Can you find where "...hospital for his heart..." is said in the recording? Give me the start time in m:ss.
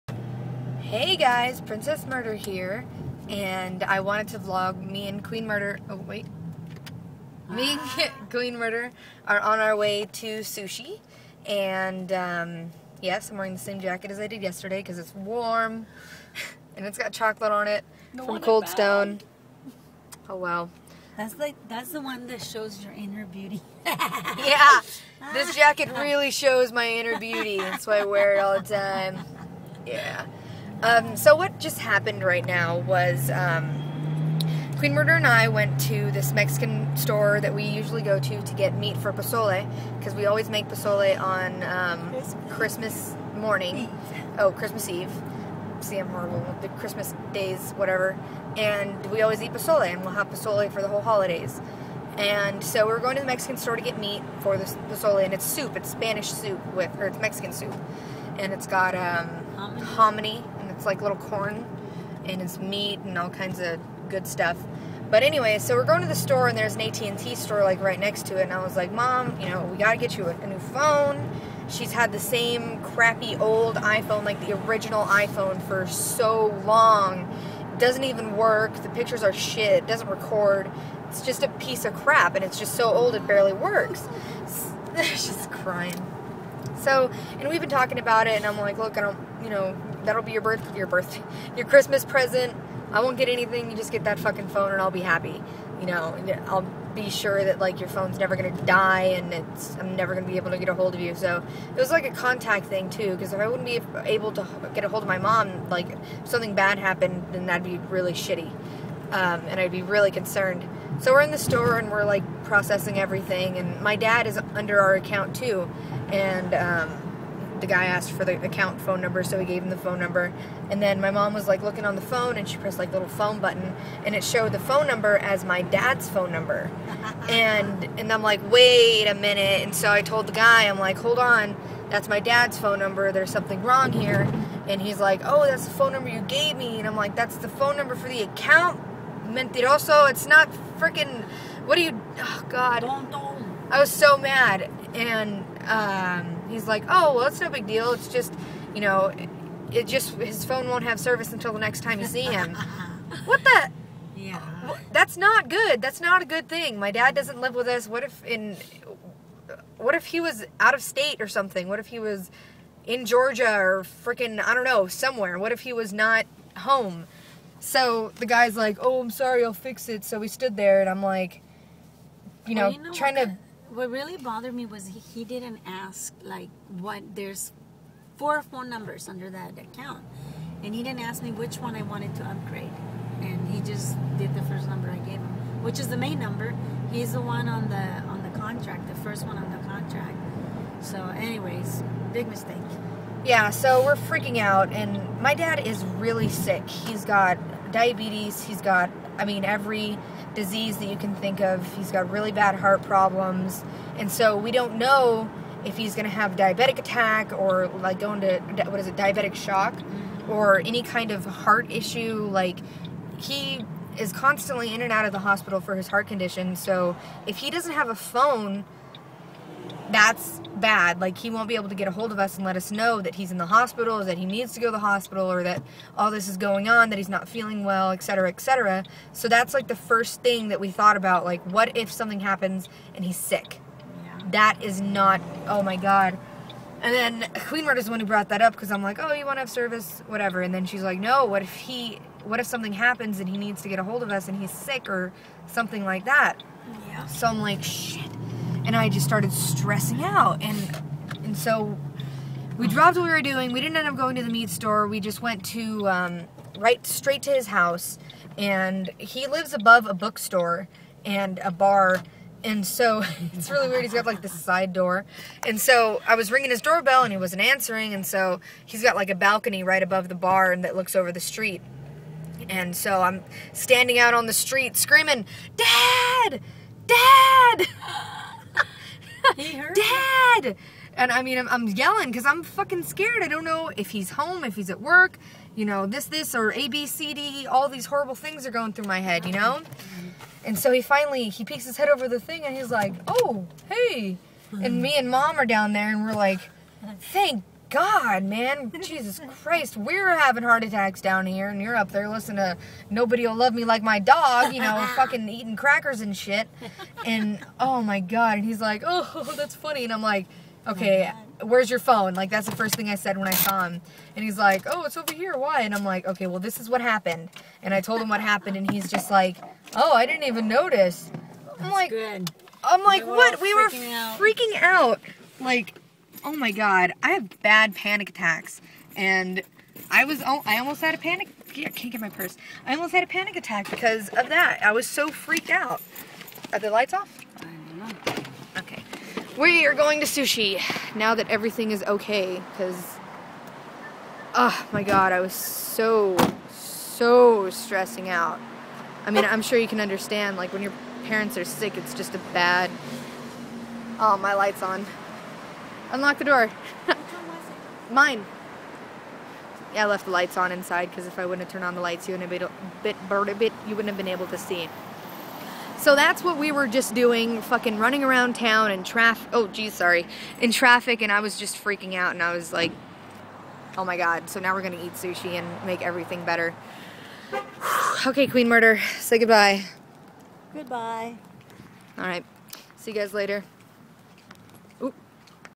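3:35.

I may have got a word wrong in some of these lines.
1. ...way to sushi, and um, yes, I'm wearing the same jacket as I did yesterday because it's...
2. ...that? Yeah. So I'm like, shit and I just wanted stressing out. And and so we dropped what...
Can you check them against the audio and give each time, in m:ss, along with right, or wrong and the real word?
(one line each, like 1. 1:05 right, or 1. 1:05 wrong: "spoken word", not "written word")
1. 0:09 right
2. 4:06 wrong: "started", not "wanted".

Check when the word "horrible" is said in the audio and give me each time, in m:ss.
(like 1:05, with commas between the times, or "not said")
0:46, 4:47.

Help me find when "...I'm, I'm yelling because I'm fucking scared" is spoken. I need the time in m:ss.
4:41.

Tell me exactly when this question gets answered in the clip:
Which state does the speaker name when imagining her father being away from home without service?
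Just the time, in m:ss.
2:43.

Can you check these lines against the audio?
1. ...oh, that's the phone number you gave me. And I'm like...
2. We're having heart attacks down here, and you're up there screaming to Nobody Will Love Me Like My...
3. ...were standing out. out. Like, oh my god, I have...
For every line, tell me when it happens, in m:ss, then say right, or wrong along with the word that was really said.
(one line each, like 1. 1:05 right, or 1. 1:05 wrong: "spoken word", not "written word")
1. 2:15 right
2. 4:59 wrong: "listening", not "screaming"
3. 5:23 wrong: "freaking", not "standing".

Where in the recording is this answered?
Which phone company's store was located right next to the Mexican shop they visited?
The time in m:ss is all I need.
1:06.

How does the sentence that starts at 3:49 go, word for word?
So that's like the first thing that we thought about.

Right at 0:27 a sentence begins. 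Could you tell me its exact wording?
That's why I wear it all the time.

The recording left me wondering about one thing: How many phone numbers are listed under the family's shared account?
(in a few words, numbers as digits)
4.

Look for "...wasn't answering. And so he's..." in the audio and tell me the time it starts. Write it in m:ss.
4:27.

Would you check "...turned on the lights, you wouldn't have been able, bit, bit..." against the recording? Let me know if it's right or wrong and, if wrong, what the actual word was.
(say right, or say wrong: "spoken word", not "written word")
right.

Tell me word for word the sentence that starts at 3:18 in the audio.
He's got, I mean, every disease that you can think of.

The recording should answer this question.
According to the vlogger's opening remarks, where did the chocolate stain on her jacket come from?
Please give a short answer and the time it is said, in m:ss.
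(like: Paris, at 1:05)
Cold Stone, at 0:18.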